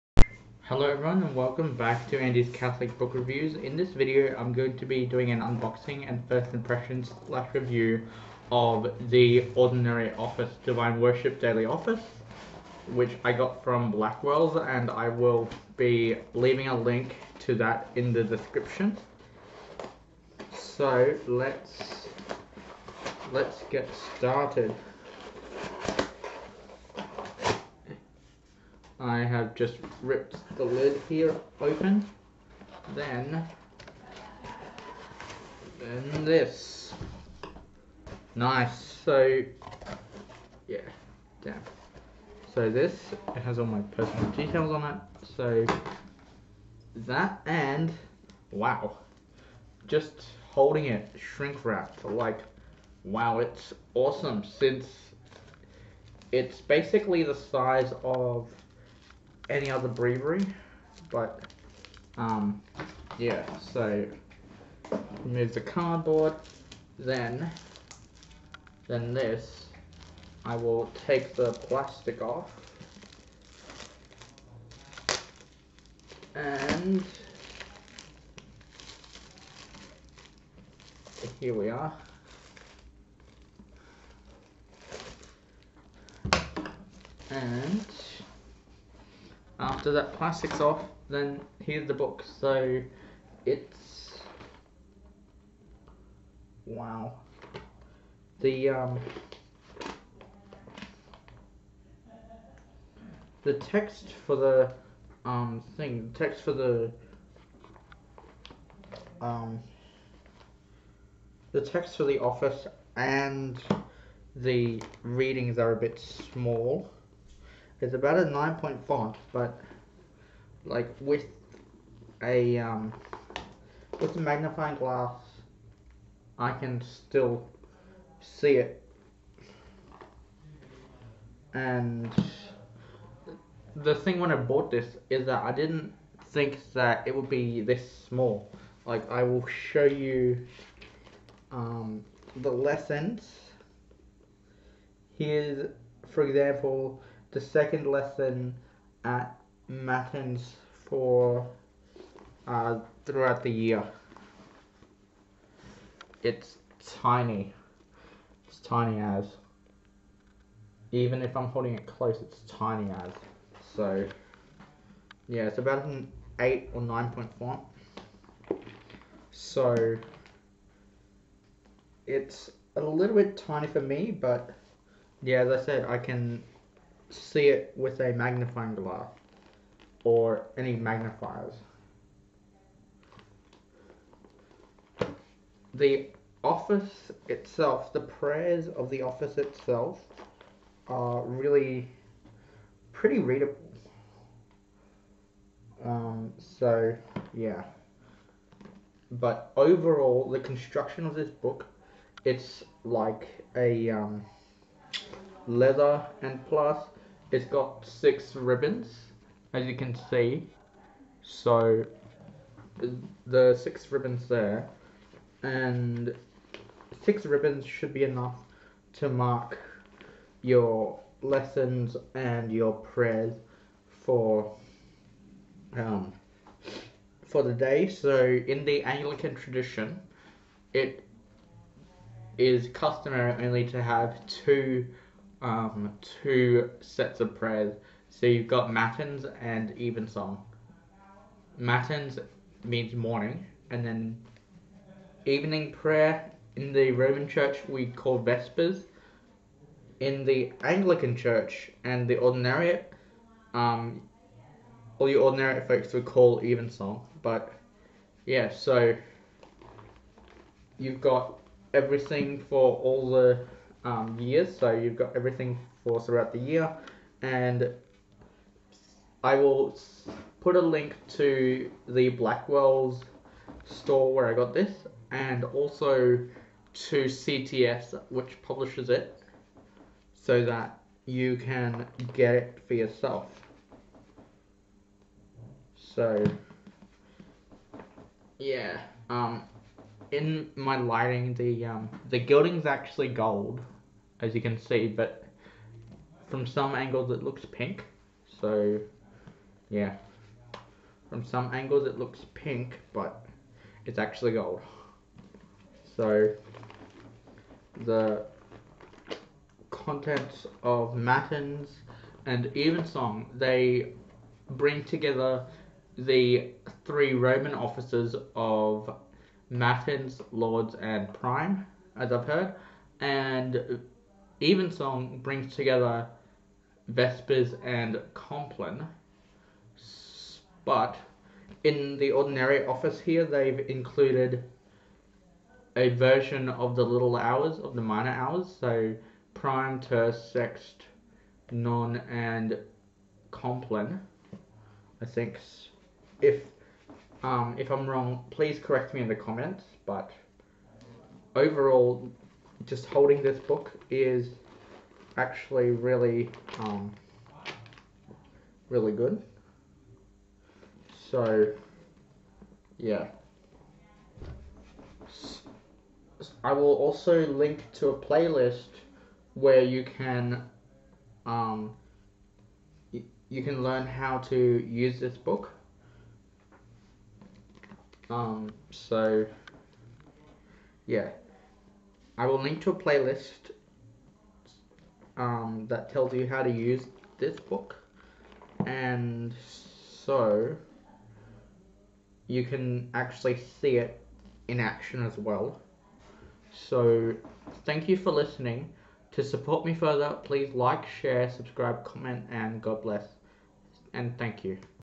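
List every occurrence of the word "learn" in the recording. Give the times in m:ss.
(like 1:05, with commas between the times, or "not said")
6:13.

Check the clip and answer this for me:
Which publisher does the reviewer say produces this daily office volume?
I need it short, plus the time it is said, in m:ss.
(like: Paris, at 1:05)
CTS, at 4:37.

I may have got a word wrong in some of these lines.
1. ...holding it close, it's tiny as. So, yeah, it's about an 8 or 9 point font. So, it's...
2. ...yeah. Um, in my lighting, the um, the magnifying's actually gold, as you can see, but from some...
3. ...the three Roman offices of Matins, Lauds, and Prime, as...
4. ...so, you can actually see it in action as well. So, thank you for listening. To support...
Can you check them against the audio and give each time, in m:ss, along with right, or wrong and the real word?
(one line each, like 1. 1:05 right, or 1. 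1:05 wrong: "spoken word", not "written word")
1. 2:41 right
2. 4:48 wrong: "gilding", not "magnifying"
3. 5:15 right
4. 6:30 right.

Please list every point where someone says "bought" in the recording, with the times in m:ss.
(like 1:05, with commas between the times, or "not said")
2:14.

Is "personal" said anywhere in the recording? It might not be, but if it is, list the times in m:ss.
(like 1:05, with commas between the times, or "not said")
0:43.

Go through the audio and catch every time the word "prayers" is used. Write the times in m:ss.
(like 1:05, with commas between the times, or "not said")
3:08, 3:42, 3:57, 4:05.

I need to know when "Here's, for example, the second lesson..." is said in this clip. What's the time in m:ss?
2:25.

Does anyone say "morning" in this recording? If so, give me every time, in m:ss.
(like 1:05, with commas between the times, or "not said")
4:02.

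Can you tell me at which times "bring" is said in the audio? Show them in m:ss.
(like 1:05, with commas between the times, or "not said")
5:14, 5:25.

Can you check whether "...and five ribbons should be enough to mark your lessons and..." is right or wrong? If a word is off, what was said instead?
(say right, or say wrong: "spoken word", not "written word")
wrong: "six", not "five".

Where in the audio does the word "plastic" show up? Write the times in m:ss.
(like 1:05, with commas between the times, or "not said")
1:11, 1:30.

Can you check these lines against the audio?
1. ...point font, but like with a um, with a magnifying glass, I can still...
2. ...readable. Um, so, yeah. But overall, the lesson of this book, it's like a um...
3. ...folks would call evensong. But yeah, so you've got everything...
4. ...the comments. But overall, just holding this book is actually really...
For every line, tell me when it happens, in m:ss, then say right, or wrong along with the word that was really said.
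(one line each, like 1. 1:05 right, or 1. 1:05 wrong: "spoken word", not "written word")
1. 1:58 right
2. 3:13 wrong: "construction", not "lesson"
3. 4:15 right
4. 5:49 right.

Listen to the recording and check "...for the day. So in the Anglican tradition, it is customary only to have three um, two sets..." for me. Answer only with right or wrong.
wrong.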